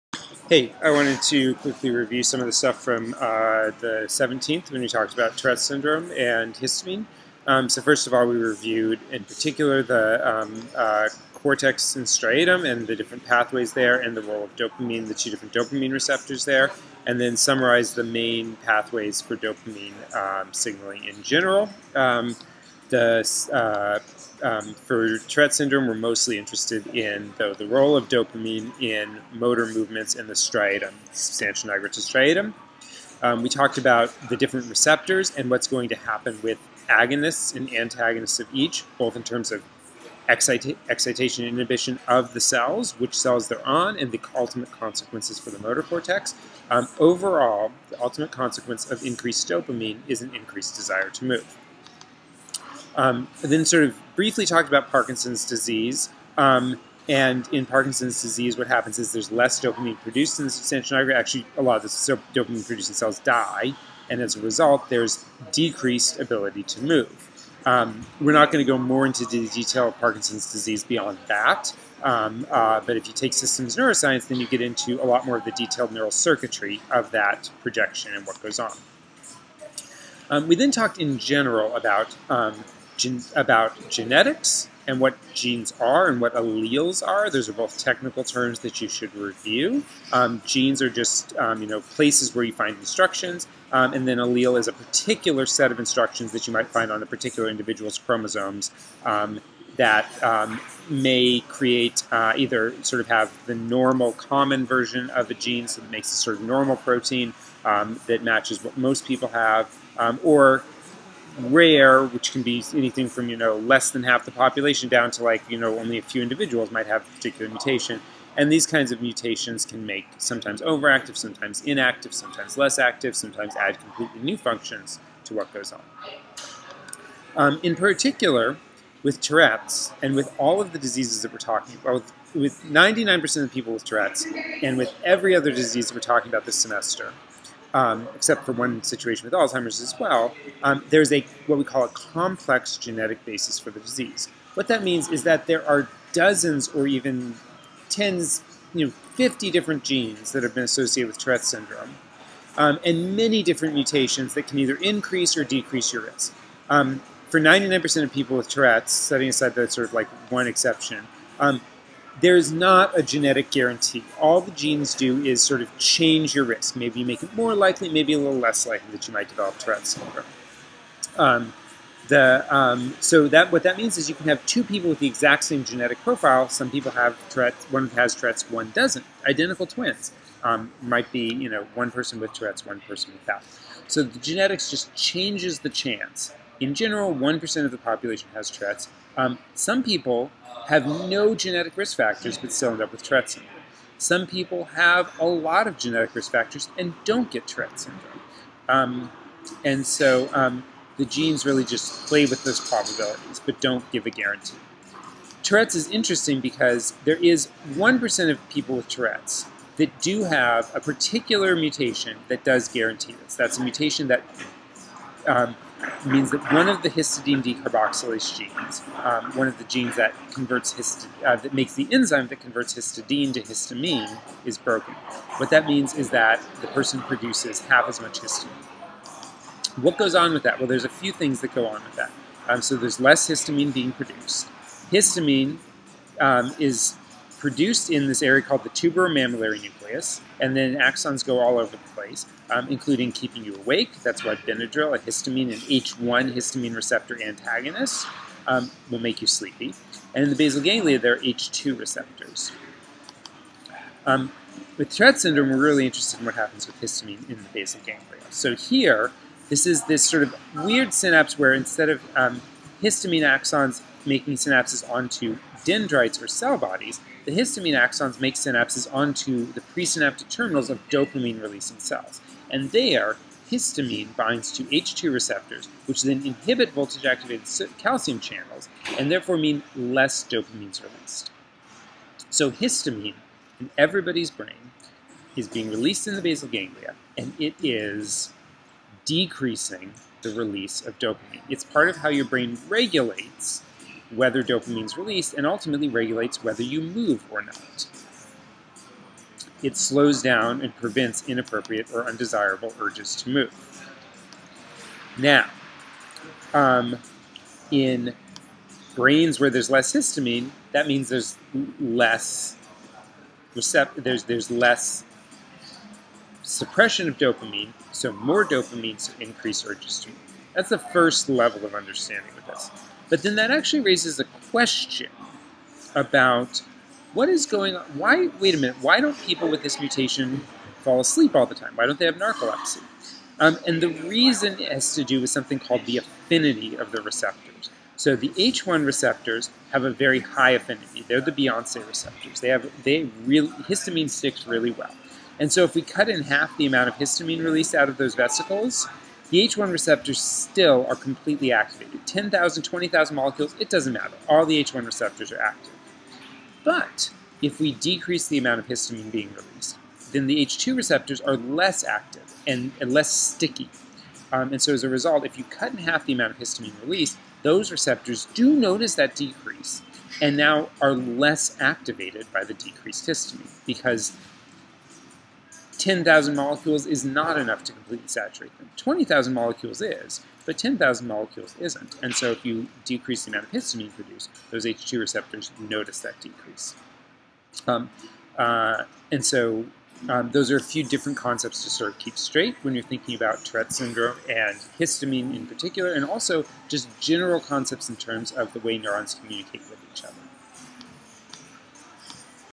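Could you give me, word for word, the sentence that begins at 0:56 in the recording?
Um, and in Parkinson's disease, what happens is there's less dopamine produced in the substantia nigra.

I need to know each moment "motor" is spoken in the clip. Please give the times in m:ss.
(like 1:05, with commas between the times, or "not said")
0:29, 0:45.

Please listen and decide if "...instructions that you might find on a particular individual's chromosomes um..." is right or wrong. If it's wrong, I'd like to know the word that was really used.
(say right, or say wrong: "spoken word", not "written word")
right.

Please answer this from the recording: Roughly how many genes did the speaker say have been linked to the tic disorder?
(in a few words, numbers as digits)
50.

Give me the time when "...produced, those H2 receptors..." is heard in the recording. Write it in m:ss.
6:23.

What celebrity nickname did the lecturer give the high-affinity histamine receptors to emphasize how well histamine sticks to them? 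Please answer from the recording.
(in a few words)
Beyonce receptors.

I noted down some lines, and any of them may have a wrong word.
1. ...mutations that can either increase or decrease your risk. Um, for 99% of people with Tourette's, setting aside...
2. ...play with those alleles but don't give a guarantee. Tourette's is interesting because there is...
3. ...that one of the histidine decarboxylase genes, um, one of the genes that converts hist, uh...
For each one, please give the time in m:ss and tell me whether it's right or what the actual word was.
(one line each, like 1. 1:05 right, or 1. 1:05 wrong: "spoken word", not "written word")
1. 2:33 right
2. 3:22 wrong: "probabilities", not "alleles"
3. 3:36 right.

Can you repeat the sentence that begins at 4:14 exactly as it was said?
Um, with Tourette syndrome, we're really interested in what happens with histamine in the basal ganglia.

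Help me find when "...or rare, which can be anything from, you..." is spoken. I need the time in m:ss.
1:50.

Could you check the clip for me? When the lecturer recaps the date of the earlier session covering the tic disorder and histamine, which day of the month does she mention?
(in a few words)
17th.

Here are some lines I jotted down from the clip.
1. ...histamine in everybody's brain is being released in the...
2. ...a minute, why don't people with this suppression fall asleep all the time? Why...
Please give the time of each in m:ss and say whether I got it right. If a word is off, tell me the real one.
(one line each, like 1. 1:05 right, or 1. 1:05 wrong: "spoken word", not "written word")
1. 4:42 right
2. 5:28 wrong: "mutation", not "suppression".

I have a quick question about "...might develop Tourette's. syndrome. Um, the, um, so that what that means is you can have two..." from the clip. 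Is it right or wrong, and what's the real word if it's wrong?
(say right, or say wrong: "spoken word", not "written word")
right.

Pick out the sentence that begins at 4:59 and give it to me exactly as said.
It slows down and prevents inappropriate or undesirable urges to move.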